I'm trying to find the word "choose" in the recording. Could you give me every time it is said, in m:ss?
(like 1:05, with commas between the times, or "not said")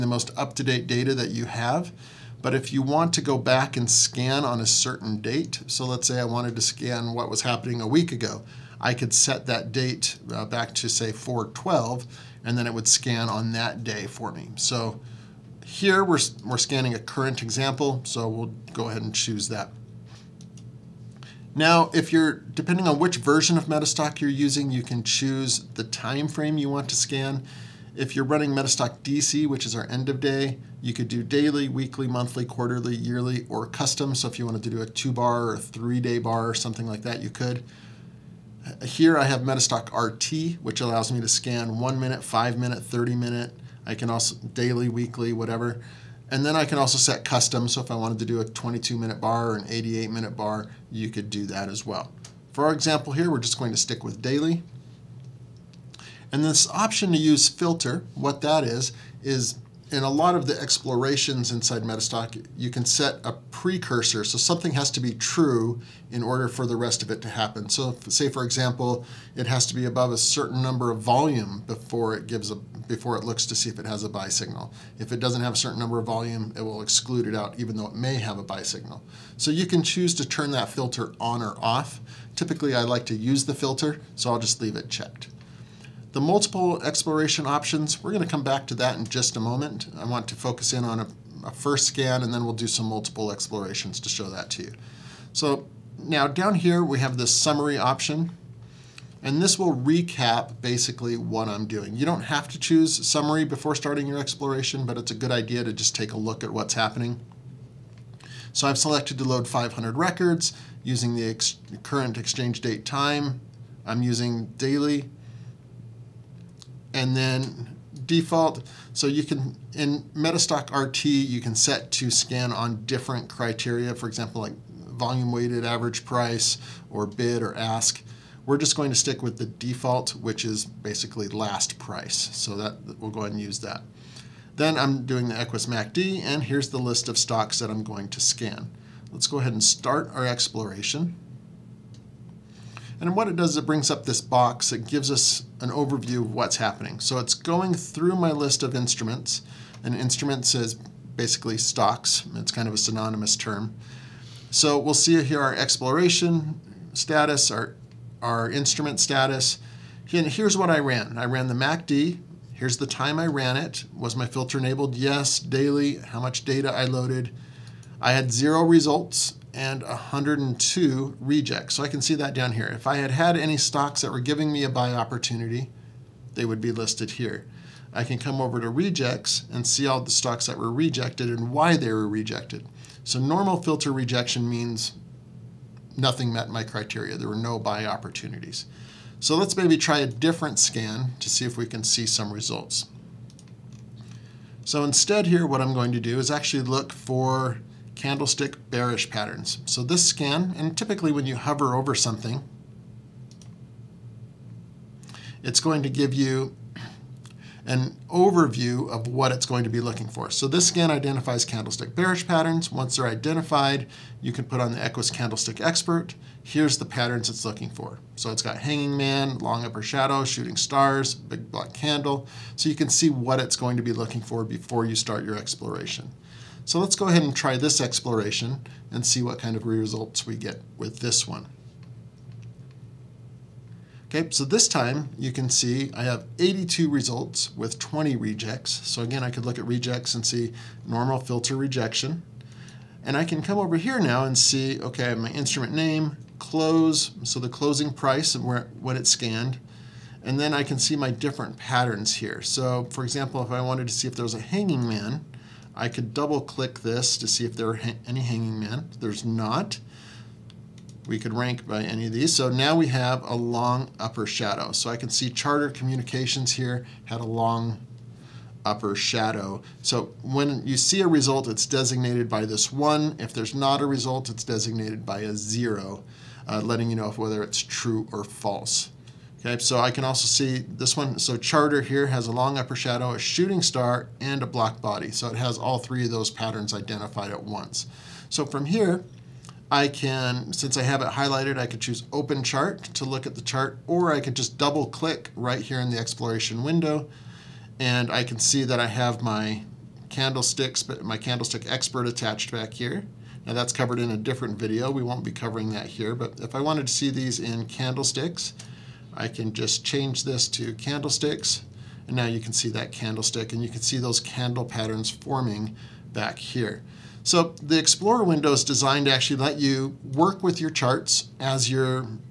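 0:19, 0:25, 1:19, 1:42, 4:51.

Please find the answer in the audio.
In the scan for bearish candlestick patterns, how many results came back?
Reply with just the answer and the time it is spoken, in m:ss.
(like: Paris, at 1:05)
82, at 3:56.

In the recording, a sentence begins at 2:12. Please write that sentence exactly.
So that we'll go ahead and use that.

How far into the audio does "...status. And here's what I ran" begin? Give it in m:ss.
2:38.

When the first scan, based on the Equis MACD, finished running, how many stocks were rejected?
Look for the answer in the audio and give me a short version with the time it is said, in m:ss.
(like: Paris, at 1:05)
102, at 2:49.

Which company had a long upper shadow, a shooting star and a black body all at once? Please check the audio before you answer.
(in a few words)
Charter Communications.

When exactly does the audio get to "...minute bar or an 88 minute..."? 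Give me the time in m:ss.
0:48.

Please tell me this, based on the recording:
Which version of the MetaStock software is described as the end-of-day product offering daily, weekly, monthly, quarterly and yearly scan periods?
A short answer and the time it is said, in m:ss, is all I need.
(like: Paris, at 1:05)
MetaStock DC, at 0:28.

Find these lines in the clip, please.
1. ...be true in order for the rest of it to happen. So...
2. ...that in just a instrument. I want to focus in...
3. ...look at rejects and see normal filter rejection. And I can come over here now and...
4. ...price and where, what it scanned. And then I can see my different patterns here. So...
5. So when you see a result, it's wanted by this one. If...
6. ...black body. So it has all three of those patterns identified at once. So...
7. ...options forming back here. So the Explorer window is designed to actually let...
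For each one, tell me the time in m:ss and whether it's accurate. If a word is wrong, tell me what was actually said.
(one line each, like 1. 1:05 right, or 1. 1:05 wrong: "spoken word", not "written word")
1. 1:05 right
2. 1:28 wrong: "moment", not "instrument"
3. 3:59 right
4. 4:07 right
5. 4:29 wrong: "designated", not "wanted"
6. 4:44 right
7. 5:14 wrong: "patterns", not "options".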